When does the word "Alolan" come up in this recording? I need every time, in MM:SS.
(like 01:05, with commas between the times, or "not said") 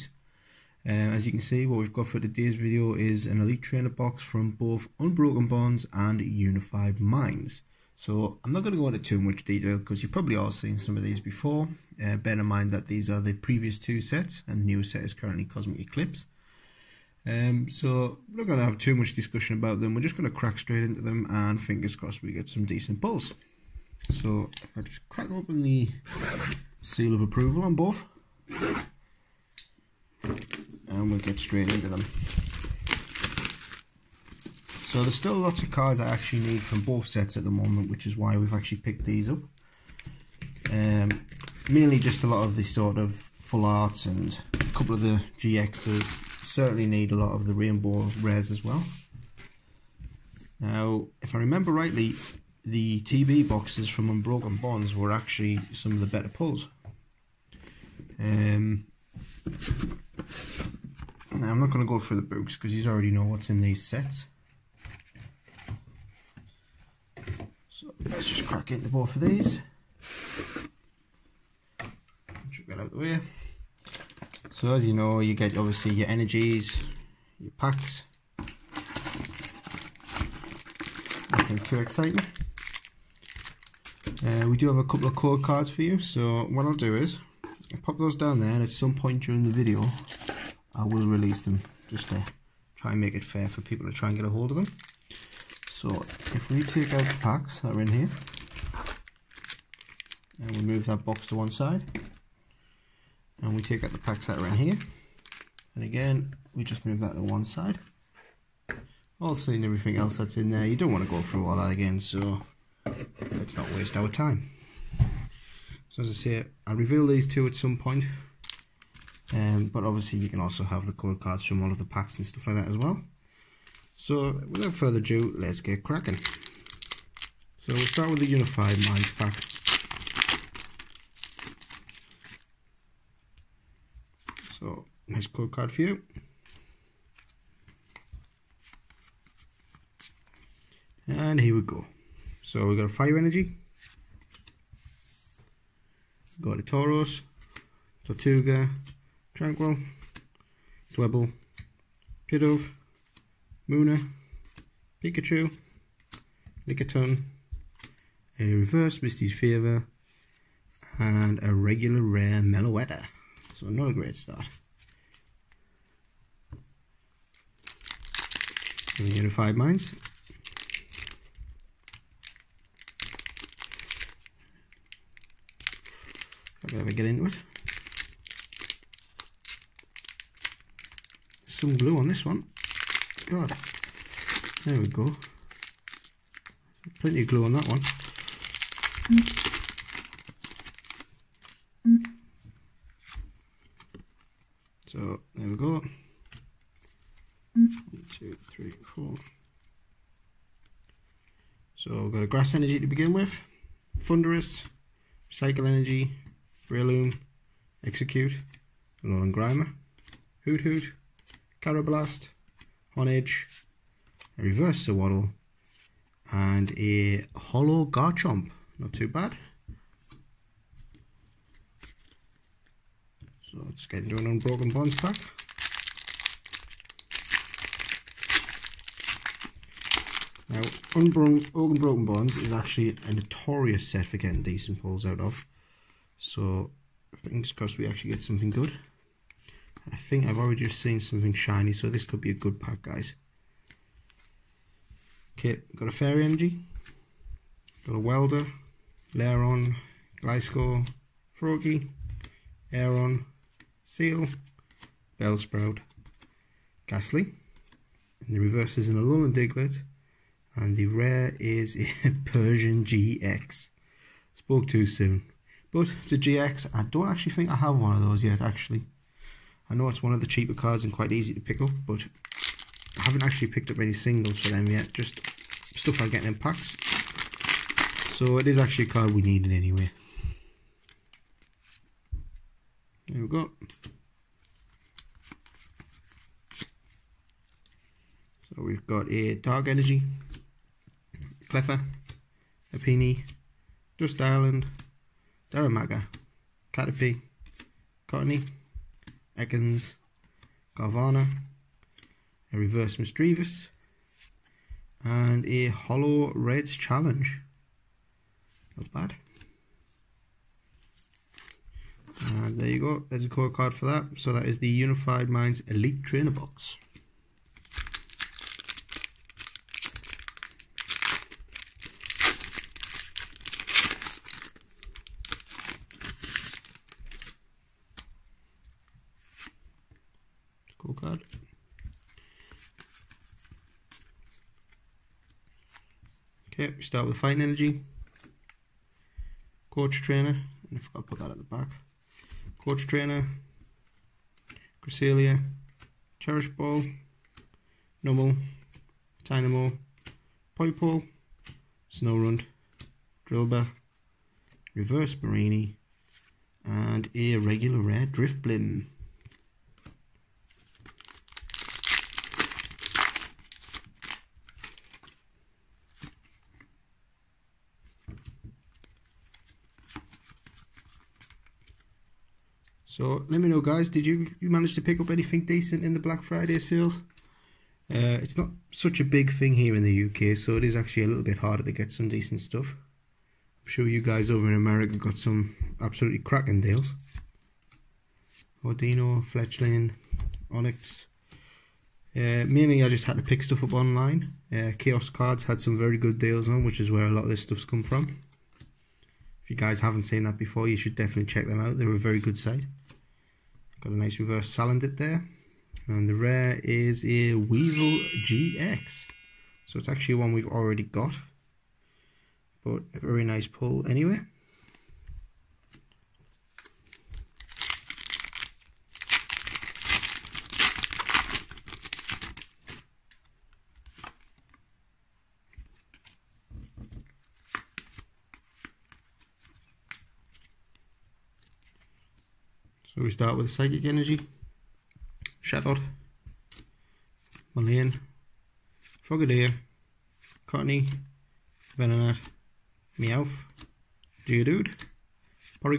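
03:29, 04:18.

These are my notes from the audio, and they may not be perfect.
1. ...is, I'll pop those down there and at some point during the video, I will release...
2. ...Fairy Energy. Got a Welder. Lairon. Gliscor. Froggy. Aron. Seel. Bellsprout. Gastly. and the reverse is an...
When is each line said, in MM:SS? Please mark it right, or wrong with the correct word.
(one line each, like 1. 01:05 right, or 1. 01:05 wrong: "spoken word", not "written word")
1. 01:26 right
2. 04:05 right.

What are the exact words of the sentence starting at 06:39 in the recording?
If you guys haven't seen that before, you should definitely check them out.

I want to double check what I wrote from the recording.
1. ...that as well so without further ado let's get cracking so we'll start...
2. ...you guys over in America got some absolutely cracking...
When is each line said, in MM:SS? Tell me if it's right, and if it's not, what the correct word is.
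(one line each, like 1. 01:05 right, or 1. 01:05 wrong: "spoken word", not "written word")
1. 02:02 right
2. 06:23 right.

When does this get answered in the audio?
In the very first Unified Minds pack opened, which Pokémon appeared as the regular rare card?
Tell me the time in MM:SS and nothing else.
02:42.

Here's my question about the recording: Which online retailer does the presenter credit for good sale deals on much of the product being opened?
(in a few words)
Chaos Cards.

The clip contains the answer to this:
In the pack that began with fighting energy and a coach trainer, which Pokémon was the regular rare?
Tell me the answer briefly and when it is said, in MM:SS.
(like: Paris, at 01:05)
Drifblim, at 05:58.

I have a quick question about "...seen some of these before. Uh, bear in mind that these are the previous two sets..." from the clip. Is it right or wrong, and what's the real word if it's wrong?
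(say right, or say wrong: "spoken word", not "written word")
right.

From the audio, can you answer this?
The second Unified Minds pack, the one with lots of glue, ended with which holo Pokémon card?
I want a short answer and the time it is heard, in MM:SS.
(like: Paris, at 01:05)
Garchomp, at 03:37.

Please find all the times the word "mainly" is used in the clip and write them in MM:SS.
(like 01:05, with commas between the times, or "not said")
00:41, 06:32.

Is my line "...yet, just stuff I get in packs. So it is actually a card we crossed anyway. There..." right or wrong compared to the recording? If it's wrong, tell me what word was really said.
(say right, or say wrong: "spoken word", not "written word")
wrong: "needed", not "crossed".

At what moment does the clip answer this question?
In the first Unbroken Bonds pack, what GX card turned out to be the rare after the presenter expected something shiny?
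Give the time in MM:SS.
04:22.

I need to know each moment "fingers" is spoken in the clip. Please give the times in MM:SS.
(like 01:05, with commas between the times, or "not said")
00:21, 03:57.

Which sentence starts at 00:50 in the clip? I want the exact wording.
Now, if I remember rightly, the TB boxes from Unbroken Bonds were actually some of the better pulls.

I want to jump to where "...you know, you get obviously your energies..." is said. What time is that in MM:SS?
01:14.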